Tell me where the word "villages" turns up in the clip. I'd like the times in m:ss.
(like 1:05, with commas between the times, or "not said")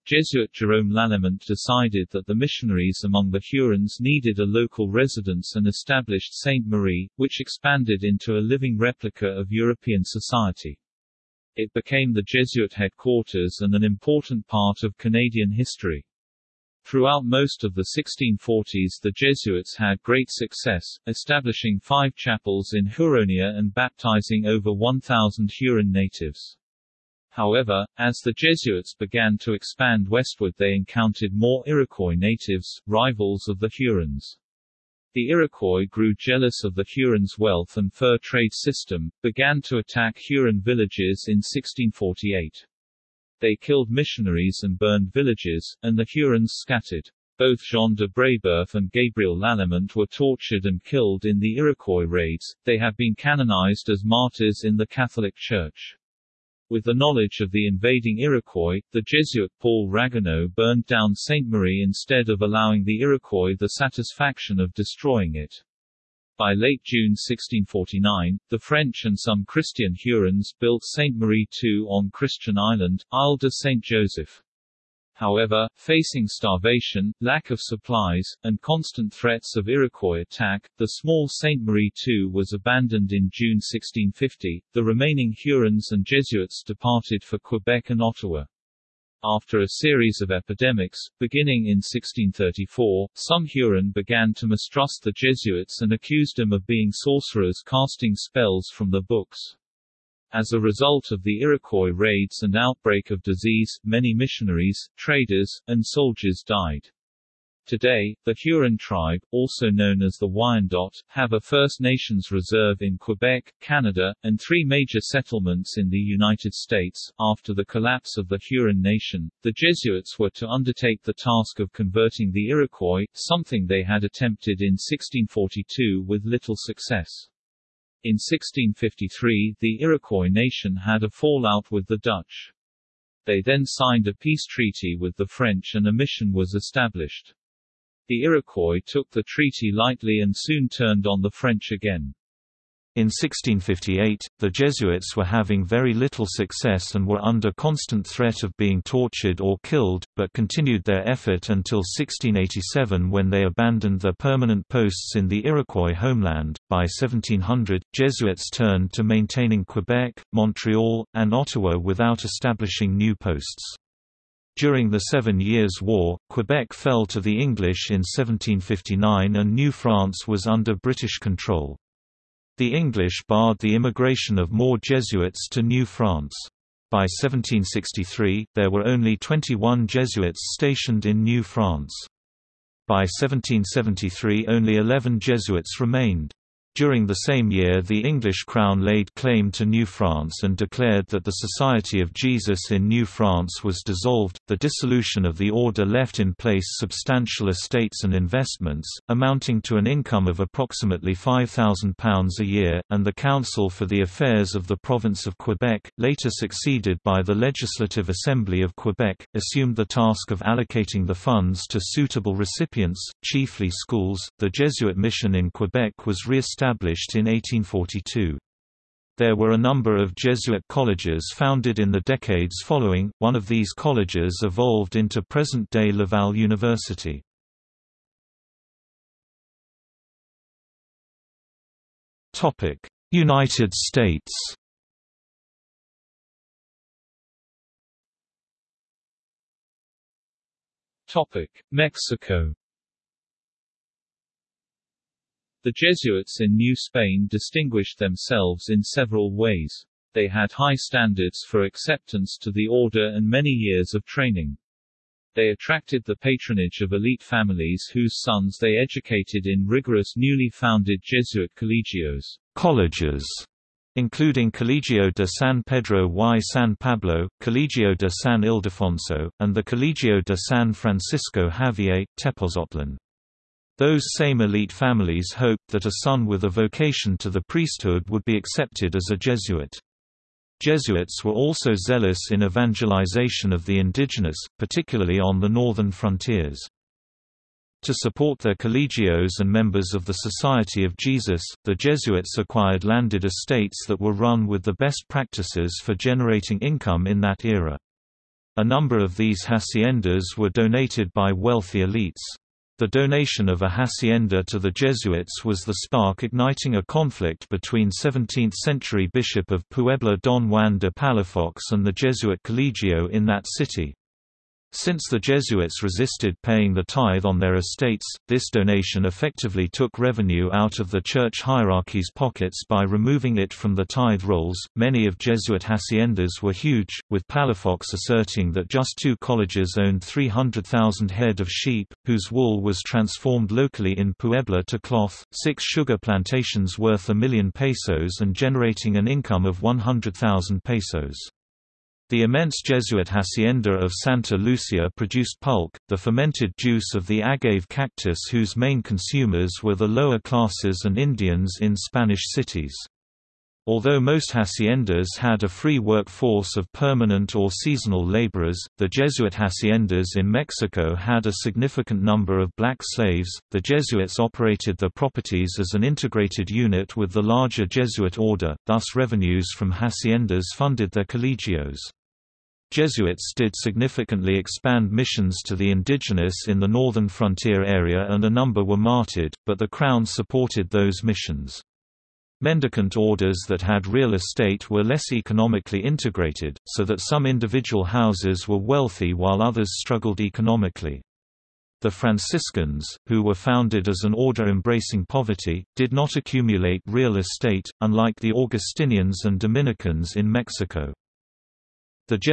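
0:40, 0:45.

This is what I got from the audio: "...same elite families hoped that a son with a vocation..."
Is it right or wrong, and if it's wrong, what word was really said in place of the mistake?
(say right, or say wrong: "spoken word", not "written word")
right.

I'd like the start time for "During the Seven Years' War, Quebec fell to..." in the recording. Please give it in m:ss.
2:44.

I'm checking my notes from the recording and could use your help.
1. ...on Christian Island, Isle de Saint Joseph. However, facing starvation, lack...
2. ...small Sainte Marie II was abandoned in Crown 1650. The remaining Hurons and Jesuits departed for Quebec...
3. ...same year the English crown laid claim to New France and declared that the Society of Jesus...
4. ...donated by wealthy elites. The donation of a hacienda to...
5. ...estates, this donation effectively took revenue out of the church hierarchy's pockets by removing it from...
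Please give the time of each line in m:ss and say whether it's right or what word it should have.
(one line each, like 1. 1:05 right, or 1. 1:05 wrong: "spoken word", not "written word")
1. 1:11 right
2. 1:20 wrong: "June", not "Crown"
3. 3:07 right
4. 5:00 right
5. 5:17 right.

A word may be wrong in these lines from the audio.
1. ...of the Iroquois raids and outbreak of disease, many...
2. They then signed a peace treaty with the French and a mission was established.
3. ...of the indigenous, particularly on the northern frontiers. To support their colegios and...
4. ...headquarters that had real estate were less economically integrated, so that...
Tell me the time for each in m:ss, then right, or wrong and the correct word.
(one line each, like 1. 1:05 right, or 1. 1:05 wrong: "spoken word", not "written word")
1. 1:41 right
2. 2:13 right
3. 4:43 right
4. 6:22 wrong: "orders", not "headquarters".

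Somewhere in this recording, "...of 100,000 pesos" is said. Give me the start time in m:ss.
5:39.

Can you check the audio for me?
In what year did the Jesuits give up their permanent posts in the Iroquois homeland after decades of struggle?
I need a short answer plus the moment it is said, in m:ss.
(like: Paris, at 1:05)
1687, at 2:31.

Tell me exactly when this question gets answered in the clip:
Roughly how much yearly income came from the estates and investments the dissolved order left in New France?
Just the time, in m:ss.
3:21.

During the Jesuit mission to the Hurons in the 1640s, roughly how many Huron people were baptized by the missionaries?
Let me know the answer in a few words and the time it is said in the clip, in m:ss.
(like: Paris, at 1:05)
over 1,000, at 0:24.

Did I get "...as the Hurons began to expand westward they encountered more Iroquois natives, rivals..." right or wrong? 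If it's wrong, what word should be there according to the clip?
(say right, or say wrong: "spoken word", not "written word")
wrong: "Jesuits", not "Hurons".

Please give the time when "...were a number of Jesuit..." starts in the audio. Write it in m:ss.
3:39.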